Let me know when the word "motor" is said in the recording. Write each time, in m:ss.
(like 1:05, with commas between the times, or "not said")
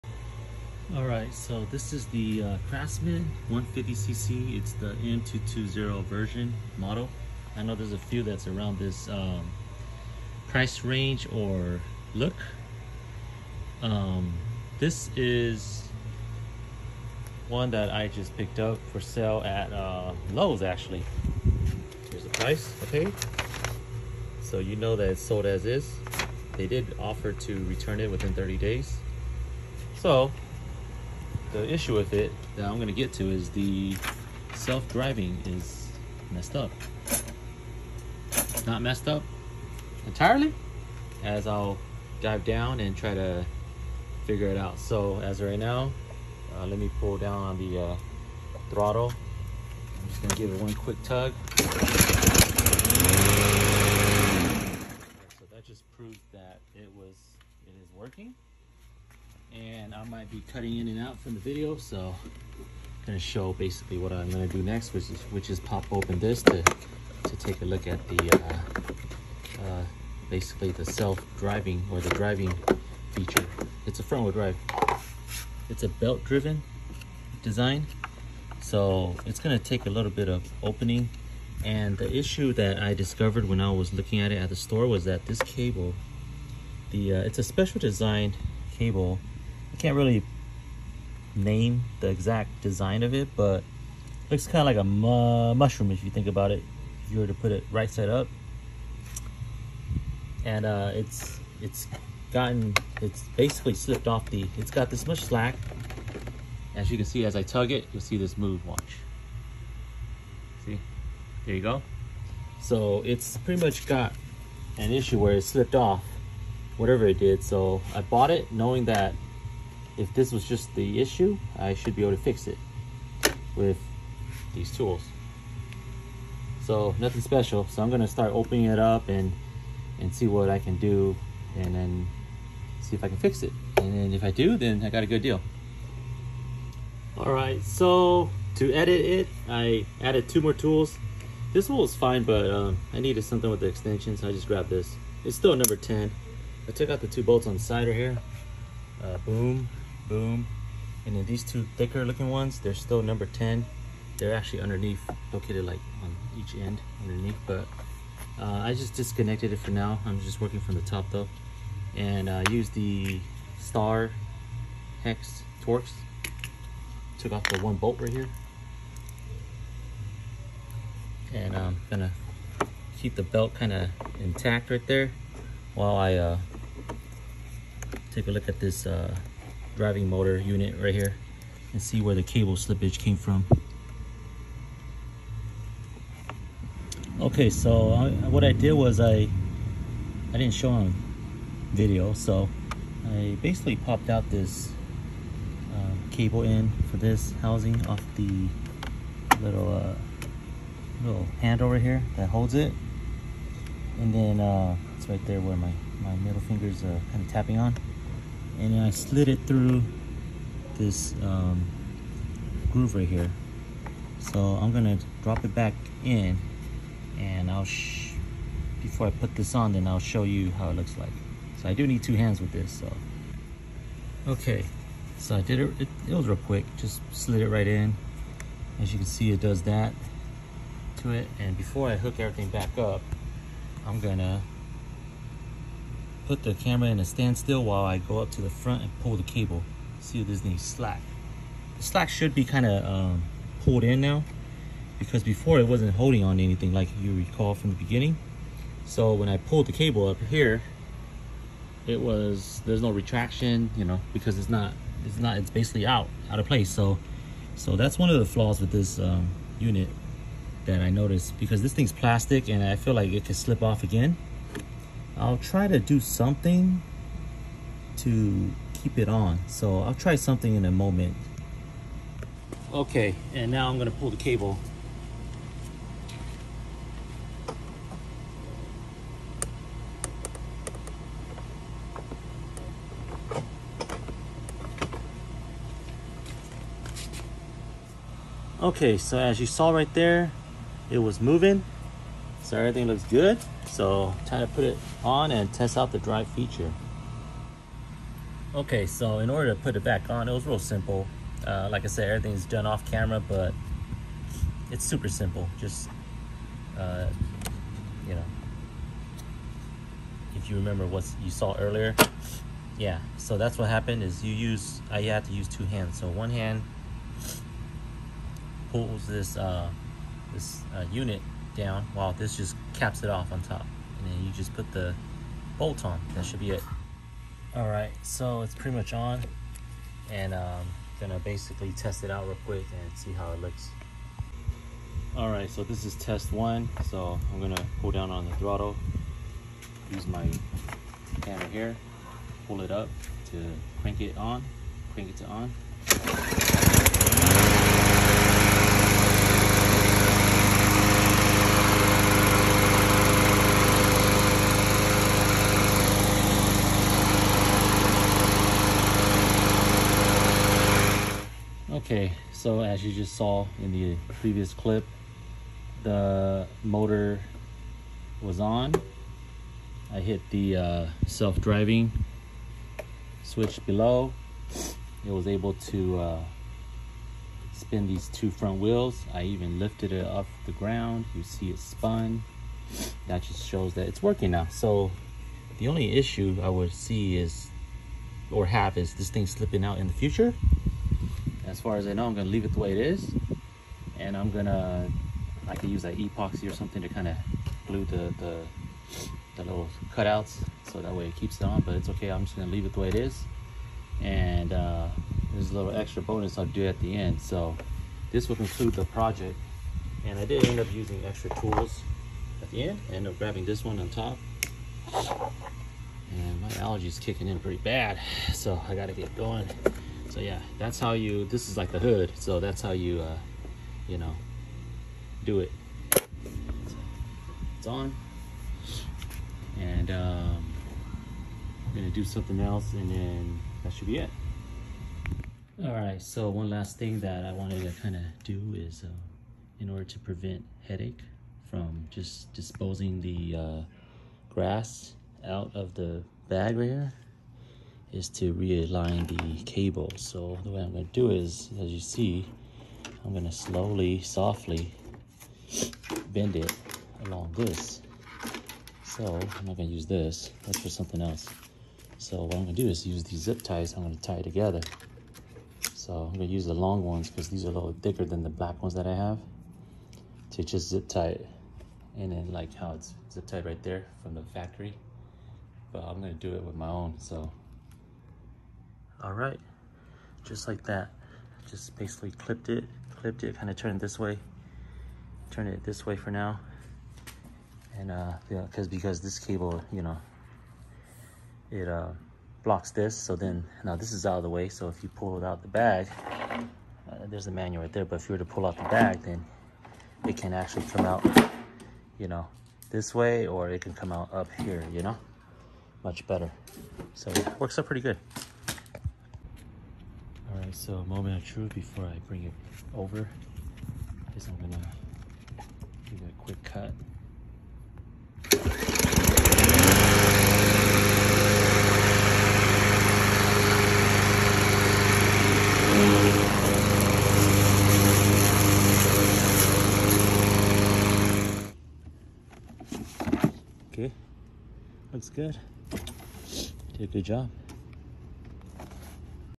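3:00, 6:06.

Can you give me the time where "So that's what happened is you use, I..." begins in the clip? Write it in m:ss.
5:13.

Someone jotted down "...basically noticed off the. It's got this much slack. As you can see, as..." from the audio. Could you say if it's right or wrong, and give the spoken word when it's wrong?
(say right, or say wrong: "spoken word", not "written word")
wrong: "slipped", not "noticed".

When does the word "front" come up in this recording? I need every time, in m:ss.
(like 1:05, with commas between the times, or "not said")
1:14, 3:58, 6:18.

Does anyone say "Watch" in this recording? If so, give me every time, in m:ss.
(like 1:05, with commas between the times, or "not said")
1:48.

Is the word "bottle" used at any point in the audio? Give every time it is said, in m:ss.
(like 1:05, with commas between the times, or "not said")
not said.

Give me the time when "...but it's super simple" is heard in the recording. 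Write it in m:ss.
5:03.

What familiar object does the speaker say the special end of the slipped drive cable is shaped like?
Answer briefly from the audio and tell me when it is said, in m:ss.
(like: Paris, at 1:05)
mushroom, at 1:35.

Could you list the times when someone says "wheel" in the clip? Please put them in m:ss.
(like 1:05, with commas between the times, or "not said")
1:14, 6:18.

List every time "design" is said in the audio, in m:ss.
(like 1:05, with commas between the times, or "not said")
1:17, 1:27, 1:32.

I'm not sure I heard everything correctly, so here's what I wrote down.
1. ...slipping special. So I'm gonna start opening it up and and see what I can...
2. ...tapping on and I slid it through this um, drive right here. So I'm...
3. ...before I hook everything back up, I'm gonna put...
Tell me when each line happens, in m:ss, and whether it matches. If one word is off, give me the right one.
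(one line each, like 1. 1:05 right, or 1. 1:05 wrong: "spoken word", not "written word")
1. 2:06 wrong: "nothing", not "slipping"
2. 3:27 wrong: "groove", not "drive"
3. 3:51 right.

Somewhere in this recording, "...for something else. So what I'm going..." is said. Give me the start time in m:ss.
7:40.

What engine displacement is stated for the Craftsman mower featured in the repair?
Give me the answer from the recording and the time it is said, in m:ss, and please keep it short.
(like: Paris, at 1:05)
150cc, at 0:03.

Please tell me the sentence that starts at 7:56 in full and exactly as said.
So all right, just like that.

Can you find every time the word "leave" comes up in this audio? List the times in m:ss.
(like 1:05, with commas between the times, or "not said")
6:32, 6:42.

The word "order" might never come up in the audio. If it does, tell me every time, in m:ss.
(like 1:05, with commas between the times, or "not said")
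4:59, 7:19.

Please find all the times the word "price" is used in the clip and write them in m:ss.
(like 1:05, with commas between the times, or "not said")
0:10, 0:22.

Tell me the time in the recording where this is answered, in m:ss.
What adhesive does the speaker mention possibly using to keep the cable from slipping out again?
6:35.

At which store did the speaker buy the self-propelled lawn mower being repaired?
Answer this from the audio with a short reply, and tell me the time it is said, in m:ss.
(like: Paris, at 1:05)
Lowe's, at 0:20.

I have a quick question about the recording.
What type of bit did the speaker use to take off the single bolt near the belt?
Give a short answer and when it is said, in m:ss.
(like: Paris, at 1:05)
Star Hex Torx, at 2:43.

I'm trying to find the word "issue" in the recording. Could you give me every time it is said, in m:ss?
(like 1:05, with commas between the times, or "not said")
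0:31, 1:22, 1:54, 2:01, 6:25.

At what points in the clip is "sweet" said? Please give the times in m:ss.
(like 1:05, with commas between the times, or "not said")
not said.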